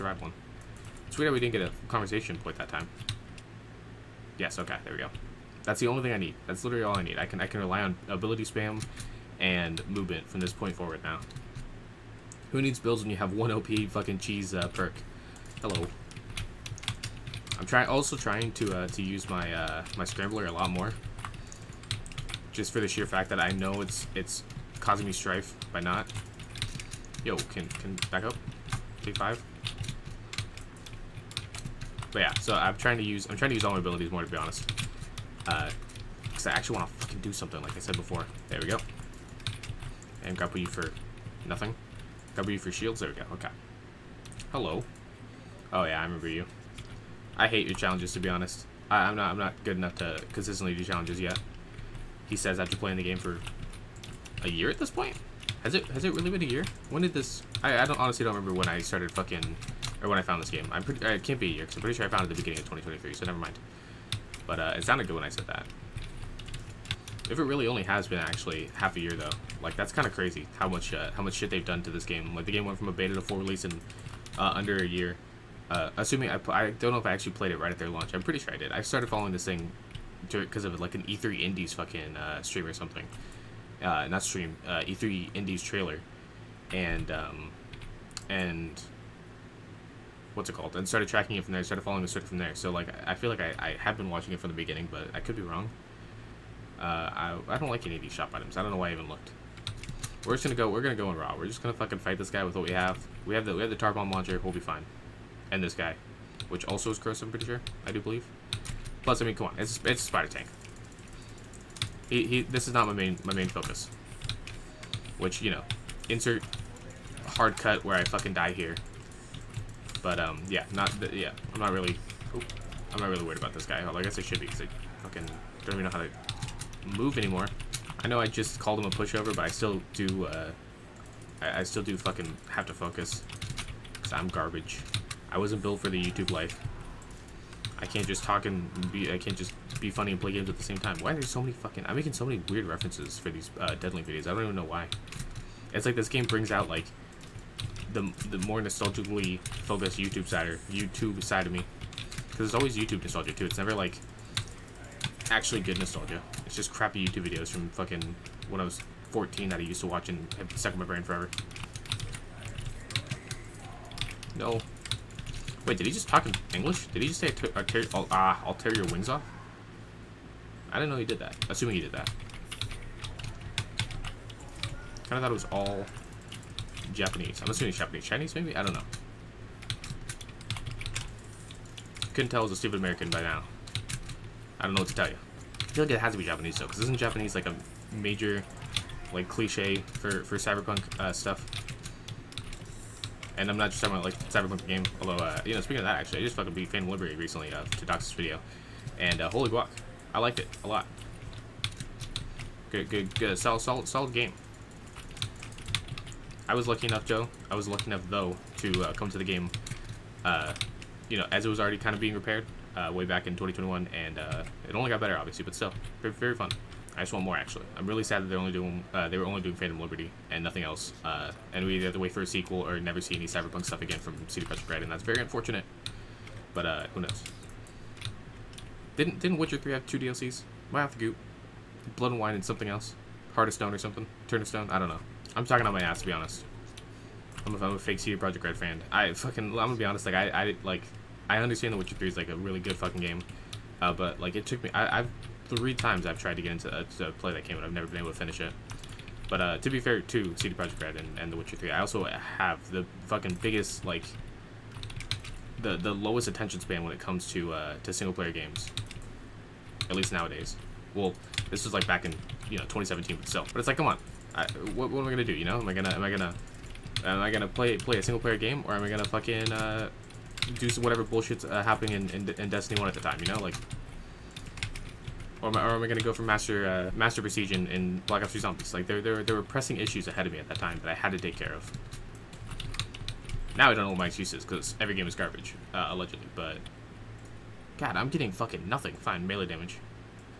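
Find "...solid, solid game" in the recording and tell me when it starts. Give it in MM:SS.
03:23.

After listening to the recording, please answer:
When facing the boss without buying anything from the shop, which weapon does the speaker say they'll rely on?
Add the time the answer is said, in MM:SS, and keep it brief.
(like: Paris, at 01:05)
tar bomb launcher, at 01:43.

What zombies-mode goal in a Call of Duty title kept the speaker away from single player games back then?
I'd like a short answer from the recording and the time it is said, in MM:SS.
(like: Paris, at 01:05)
Master Prestige, at 04:36.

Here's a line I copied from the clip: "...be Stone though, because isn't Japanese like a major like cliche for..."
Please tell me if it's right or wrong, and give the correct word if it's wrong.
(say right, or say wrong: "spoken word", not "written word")
wrong: "Japanese", not "Stone".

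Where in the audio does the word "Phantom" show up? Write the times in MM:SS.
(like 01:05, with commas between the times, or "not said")
03:16, 03:39.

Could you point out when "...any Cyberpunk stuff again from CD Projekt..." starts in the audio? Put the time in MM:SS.
03:43.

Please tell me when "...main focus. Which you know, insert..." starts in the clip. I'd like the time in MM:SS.
01:53.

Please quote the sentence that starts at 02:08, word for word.
I know I just called him a pushover, but I still do, uh, I, I still do fucking have to focus.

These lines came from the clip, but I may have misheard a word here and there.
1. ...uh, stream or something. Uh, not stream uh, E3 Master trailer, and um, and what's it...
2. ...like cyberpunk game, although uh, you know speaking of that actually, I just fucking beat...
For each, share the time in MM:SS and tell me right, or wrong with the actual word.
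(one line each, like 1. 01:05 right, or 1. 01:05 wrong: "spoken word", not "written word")
1. 01:22 wrong: "Indies", not "Master"
2. 03:14 right.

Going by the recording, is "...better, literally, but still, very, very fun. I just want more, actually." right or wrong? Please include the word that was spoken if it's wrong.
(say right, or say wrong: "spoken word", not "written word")
wrong: "obviously", not "literally".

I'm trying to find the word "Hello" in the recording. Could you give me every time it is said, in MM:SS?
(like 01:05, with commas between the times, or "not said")
00:15, 00:44.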